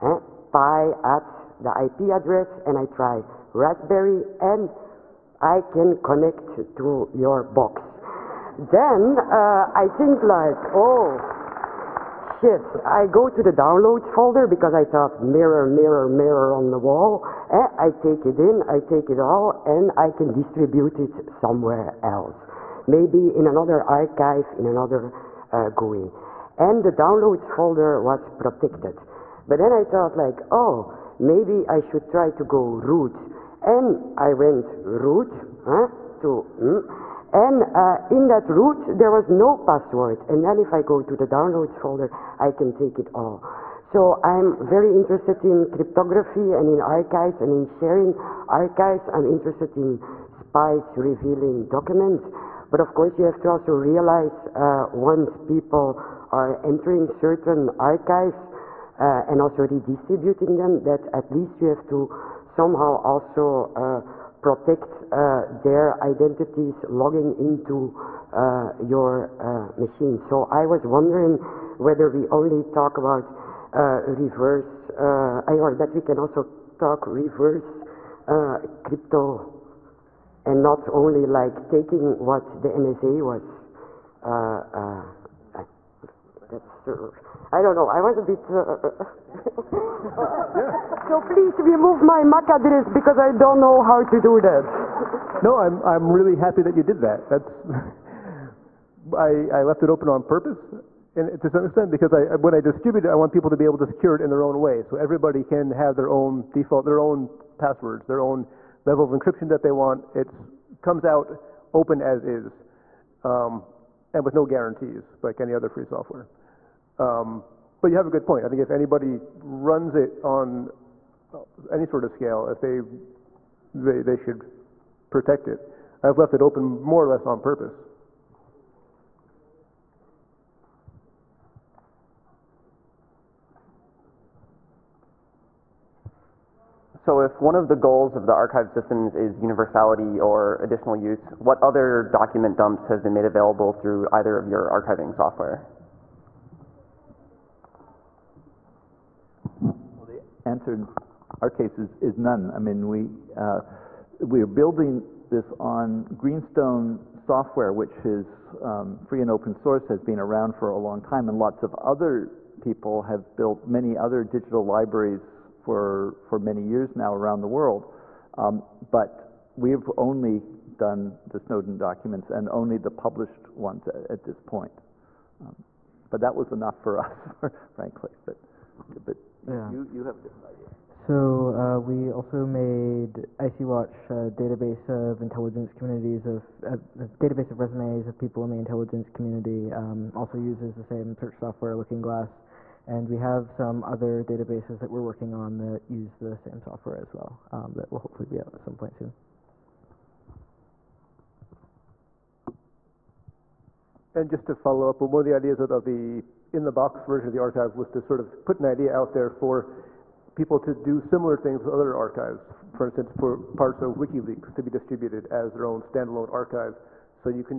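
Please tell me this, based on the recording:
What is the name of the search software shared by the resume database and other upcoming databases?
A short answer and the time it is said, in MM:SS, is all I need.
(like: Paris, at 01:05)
Looking Glass, at 03:11.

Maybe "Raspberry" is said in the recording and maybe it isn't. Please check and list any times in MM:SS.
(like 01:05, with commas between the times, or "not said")
00:03.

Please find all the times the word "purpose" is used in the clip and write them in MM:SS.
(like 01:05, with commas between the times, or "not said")
01:40, 02:07.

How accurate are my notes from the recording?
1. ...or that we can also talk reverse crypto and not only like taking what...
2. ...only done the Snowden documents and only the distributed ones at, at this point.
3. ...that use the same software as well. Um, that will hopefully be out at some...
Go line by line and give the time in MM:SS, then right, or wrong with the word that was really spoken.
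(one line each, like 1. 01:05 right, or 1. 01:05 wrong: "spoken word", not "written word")
1. 01:14 right
2. 02:49 wrong: "published", not "distributed"
3. 03:15 right.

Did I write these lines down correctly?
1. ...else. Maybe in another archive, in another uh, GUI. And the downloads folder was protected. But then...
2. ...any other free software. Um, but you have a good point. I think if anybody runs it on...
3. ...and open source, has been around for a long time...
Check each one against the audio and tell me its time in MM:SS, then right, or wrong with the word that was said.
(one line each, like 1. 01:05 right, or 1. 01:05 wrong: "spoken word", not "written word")
1. 00:22 right
2. 01:55 right
3. 02:39 right.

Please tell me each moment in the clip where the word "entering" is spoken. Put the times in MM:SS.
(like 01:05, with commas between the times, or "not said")
00:56.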